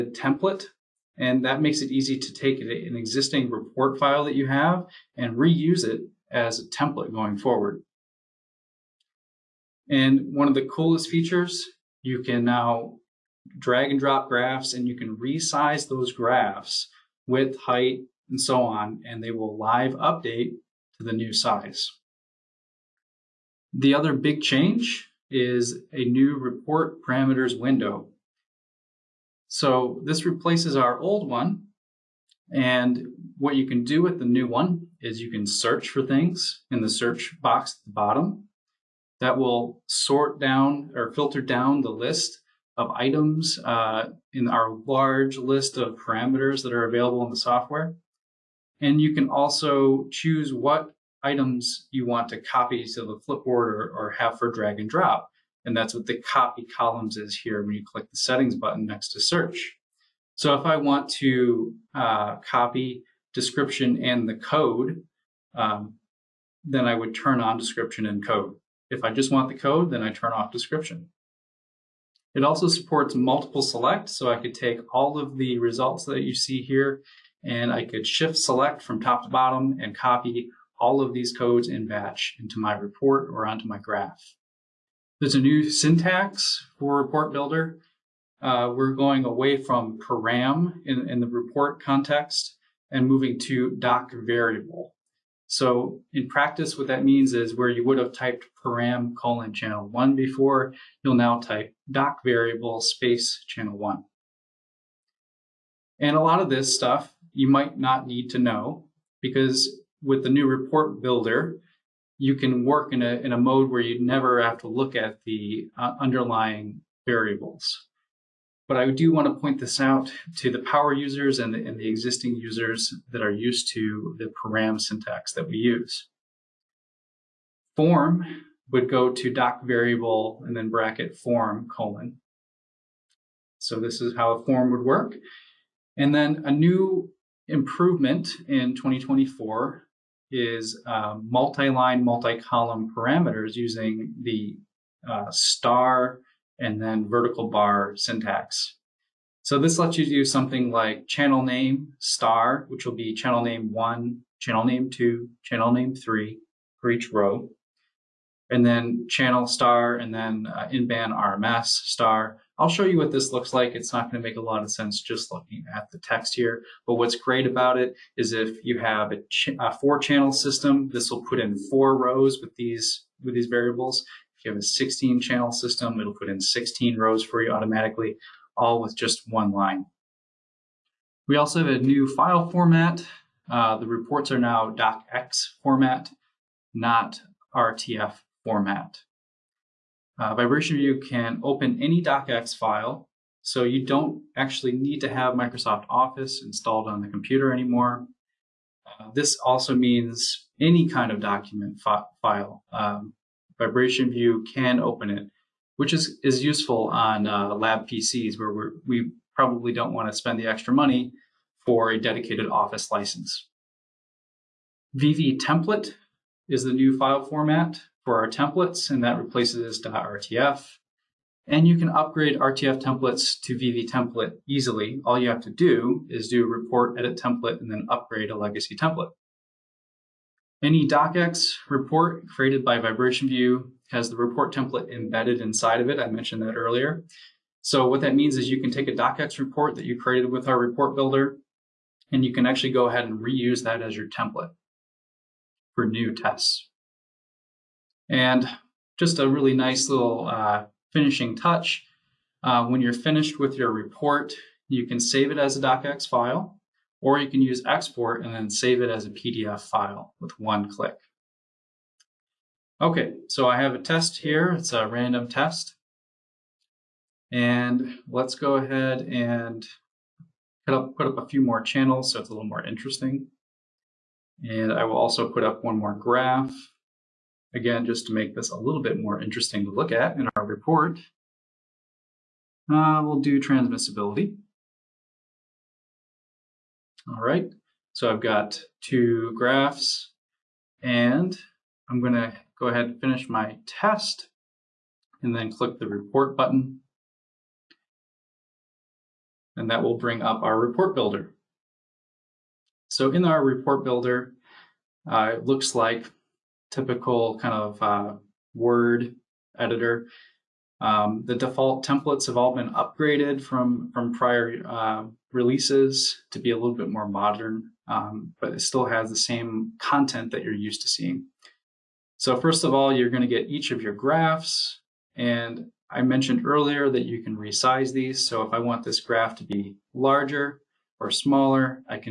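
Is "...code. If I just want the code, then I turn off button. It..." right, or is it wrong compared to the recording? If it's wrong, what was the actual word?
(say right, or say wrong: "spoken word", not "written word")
wrong: "description", not "button".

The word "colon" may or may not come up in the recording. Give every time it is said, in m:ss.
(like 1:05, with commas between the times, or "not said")
1:39, 2:11.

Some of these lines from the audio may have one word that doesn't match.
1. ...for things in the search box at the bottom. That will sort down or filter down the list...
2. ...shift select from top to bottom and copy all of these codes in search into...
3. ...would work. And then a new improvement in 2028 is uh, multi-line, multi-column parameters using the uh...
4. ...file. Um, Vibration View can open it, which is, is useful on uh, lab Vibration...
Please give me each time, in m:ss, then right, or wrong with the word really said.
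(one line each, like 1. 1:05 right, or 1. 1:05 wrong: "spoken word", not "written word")
1. 0:35 right
2. 1:18 wrong: "batch", not "search"
3. 2:14 wrong: "2024", not "2028"
4. 3:22 wrong: "PCs", not "Vibration".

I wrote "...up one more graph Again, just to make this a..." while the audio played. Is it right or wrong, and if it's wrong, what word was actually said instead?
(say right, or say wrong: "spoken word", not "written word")
right.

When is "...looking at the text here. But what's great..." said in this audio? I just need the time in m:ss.
2:45.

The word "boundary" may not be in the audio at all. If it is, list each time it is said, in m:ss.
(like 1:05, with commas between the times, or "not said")
not said.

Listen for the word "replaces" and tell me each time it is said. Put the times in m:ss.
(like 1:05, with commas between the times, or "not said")
0:30, 3:39.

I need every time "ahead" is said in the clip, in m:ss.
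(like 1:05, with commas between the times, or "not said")
4:02, 4:28, 4:52.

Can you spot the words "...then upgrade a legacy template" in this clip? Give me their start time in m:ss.
3:47.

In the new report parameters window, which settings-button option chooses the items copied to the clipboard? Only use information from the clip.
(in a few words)
Copy columns.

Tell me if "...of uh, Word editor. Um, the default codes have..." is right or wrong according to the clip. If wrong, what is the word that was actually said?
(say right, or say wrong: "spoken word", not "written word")
wrong: "templates", not "codes".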